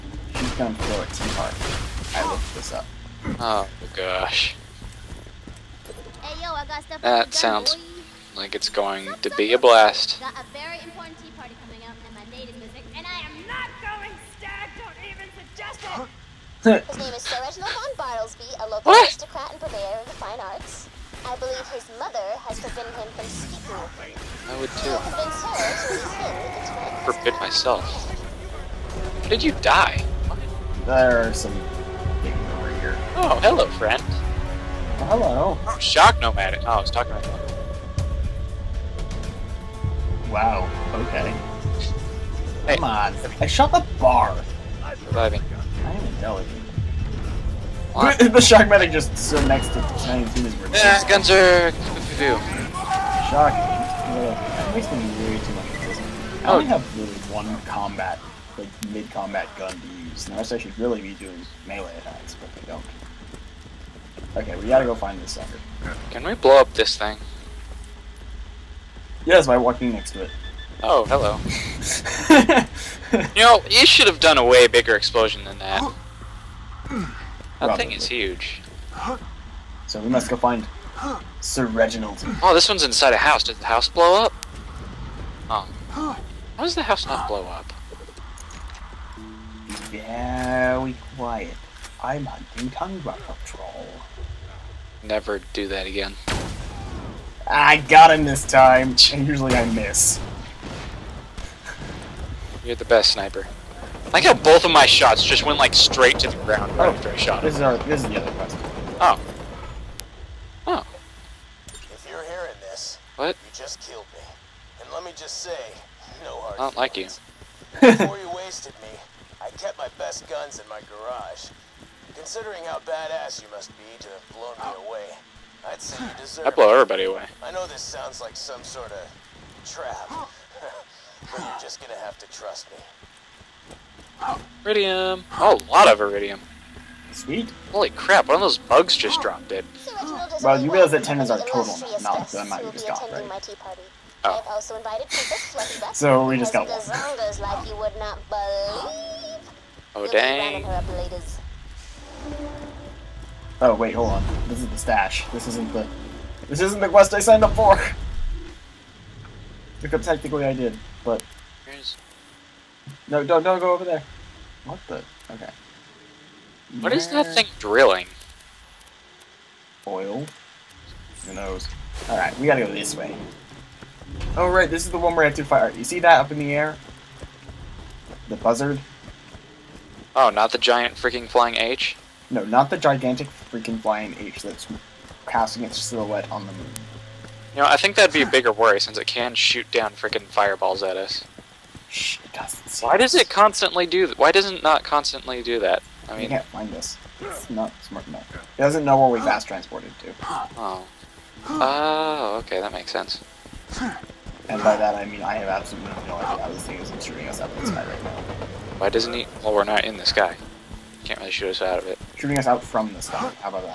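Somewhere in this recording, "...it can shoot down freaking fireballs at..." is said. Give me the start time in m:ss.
3:08.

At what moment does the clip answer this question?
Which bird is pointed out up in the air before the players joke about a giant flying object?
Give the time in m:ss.
2:58.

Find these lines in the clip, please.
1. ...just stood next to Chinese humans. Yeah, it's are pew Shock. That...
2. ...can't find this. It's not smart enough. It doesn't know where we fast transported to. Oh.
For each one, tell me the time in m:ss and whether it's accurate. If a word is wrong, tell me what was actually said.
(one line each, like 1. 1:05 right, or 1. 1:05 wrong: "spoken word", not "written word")
1. 0:48 right
2. 3:16 right.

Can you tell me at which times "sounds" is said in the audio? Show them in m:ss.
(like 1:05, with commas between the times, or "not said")
0:07, 2:07.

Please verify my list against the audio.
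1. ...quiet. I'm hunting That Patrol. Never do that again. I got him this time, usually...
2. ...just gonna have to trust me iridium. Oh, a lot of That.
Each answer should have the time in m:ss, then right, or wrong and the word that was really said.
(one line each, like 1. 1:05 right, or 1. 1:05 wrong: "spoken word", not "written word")
1. 1:31 wrong: "Tundra", not "That"
2. 2:11 wrong: "Eridium", not "That".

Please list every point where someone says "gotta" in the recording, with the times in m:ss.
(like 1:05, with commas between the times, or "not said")
1:04, 2:52.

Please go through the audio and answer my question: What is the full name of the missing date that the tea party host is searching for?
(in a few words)
Sir Reginald von Bartlesby.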